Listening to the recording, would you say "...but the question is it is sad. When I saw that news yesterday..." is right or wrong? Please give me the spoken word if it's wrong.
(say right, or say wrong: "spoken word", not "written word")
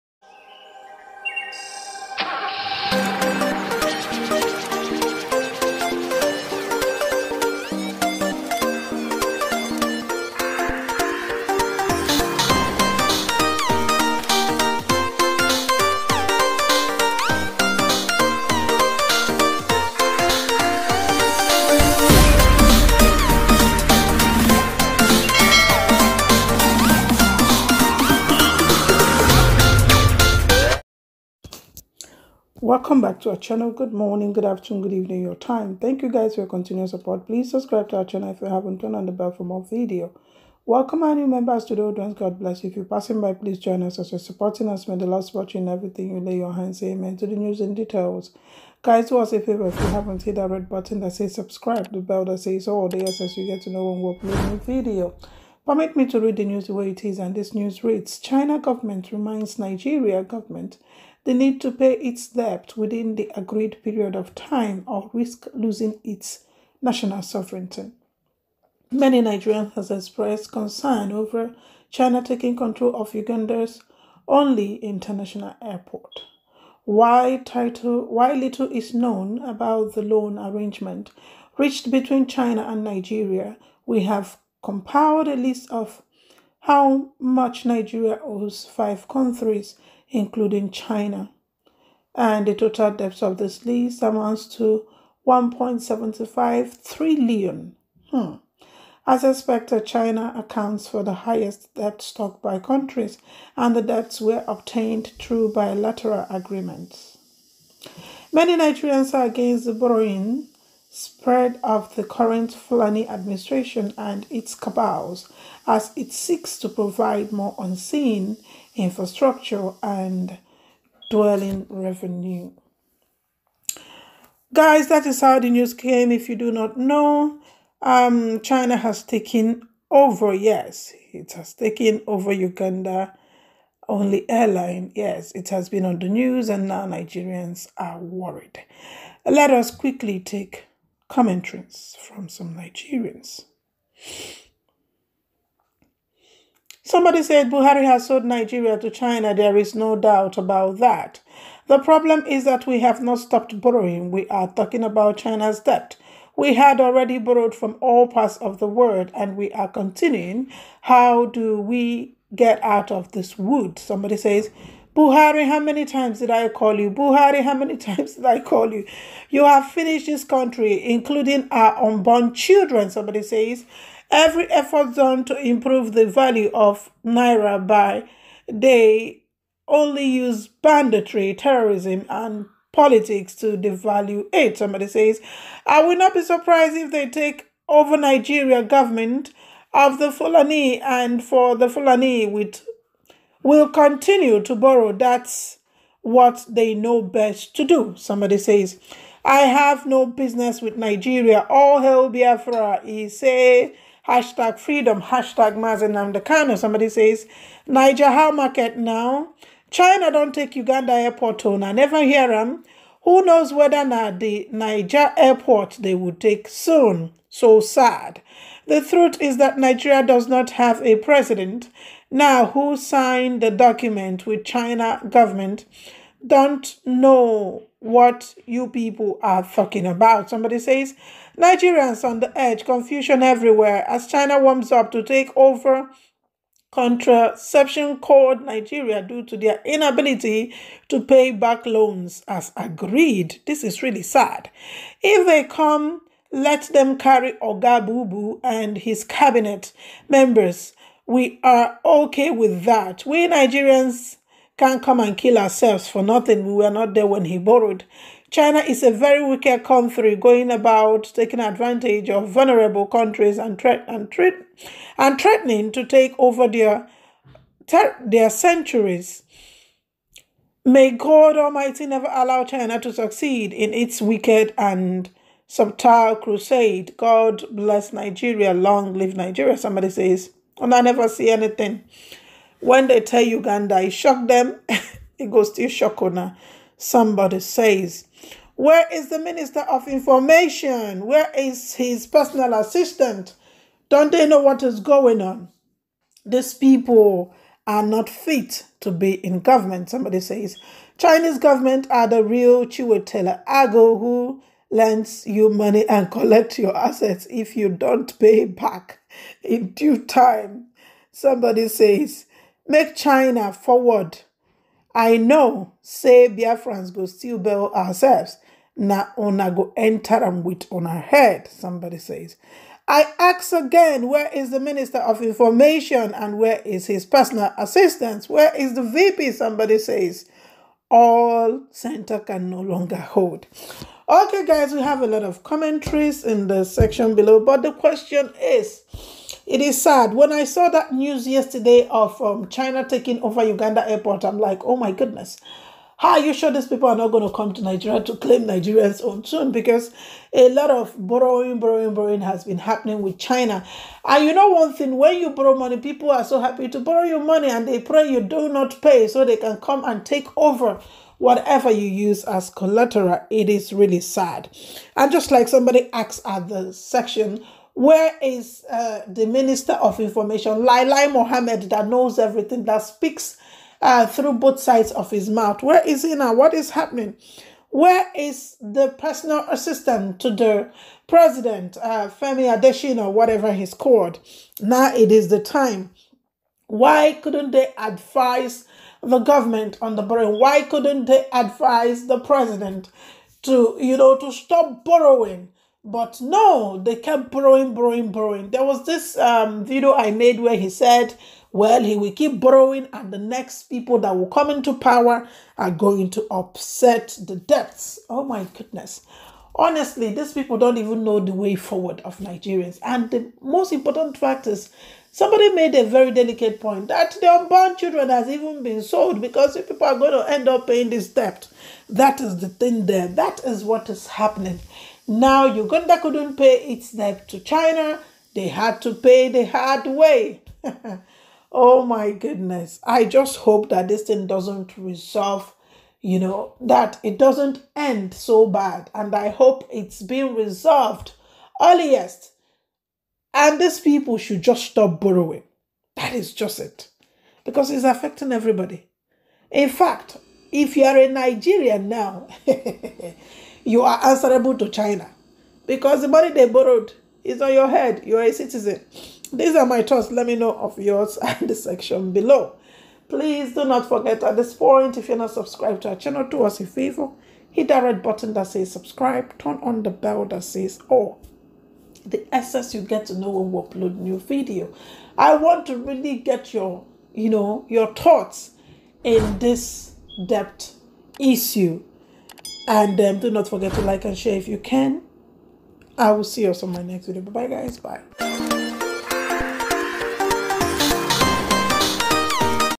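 right.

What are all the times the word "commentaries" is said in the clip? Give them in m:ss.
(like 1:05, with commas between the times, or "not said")
2:21, 5:35.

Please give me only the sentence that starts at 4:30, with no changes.
May God Almighty never allow China to succeed in its wicked and subtile crusade.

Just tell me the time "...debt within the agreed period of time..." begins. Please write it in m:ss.
1:02.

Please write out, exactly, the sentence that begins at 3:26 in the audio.
Somebody says, Niger, how market now?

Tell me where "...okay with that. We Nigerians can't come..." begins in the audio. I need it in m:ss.
4:11.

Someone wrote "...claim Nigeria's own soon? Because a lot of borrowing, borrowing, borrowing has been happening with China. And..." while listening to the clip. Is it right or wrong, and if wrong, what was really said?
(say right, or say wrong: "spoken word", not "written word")
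right.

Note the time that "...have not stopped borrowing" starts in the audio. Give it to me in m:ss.
2:32.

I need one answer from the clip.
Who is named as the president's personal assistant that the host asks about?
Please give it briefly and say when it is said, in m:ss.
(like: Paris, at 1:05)
Femi Adesina, at 6:22.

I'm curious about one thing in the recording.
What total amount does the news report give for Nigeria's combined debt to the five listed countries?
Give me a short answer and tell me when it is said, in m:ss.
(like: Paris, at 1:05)
1.75 trillion, at 1:35.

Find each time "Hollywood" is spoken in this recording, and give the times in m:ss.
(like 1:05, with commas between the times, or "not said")
not said.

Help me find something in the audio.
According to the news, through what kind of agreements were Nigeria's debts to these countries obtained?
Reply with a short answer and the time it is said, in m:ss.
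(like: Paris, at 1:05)
Bilateral agreements, at 1:45.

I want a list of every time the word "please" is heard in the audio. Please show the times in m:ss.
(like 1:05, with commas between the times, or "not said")
0:37, 0:43, 7:43.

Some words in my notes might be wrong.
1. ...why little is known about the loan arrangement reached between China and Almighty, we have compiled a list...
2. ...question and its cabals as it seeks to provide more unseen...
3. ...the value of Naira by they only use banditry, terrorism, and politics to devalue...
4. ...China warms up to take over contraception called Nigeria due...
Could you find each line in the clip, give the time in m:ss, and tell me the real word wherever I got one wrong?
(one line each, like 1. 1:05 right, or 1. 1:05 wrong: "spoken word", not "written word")
1. 1:18 wrong: "Nigeria", not "Almighty"
2. 1:53 wrong: "administration", not "question"
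3. 2:55 right
4. 3:54 right.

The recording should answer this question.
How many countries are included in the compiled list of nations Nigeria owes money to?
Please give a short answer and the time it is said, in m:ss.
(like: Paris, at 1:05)
5, at 1:28.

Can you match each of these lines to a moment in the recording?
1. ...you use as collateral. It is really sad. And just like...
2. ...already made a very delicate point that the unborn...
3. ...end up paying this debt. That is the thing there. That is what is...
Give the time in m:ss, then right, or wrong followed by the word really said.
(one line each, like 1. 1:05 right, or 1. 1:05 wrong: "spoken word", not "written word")
1. 6:01 right
2. 6:55 wrong: "somebody", not "already"
3. 7:00 right.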